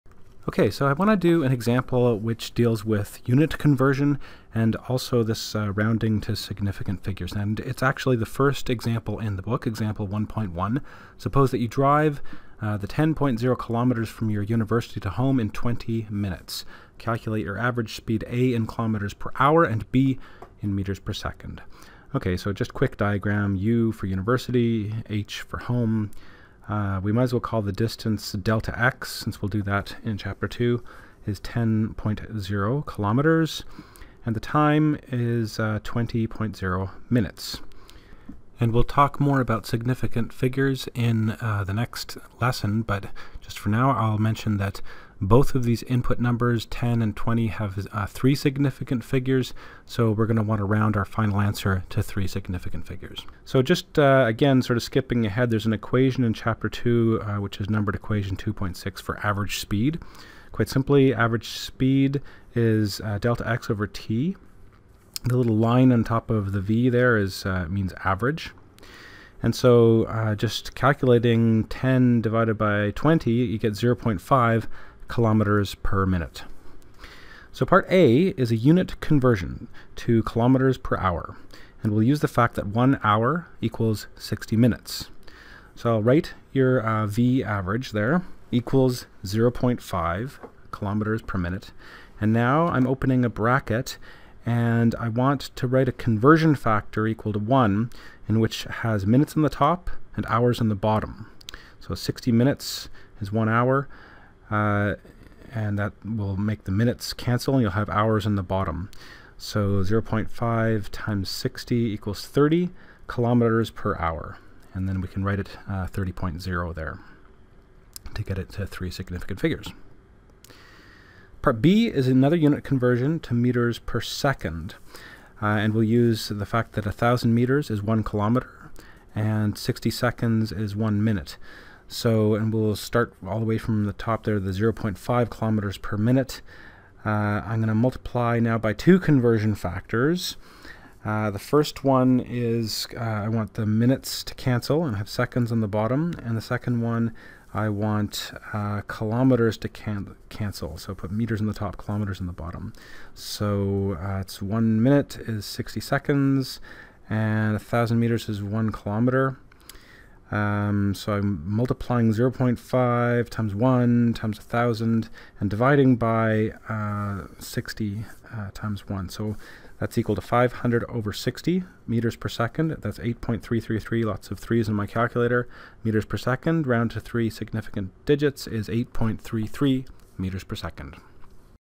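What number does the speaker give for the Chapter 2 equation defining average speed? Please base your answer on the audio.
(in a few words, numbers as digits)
2.6.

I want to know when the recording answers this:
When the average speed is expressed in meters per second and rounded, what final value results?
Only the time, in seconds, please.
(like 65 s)
178 s.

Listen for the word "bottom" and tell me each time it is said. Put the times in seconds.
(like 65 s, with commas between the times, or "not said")
100 s, 108 s, 145 s, 152 s.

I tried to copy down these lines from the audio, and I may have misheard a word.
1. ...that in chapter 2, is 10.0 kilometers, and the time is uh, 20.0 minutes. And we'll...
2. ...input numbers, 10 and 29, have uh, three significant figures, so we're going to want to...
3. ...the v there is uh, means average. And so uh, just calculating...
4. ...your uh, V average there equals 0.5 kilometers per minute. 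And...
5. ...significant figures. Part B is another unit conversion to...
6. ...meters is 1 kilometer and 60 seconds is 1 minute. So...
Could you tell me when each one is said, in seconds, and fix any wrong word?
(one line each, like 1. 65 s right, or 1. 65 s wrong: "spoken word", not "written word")
1. 29 s right
2. 45 s wrong: "20", not "29"
3. 66 s right
4. 86 s right
5. 118 s right
6. 127 s right.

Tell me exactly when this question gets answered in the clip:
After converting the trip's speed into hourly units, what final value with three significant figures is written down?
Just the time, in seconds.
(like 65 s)
115 s.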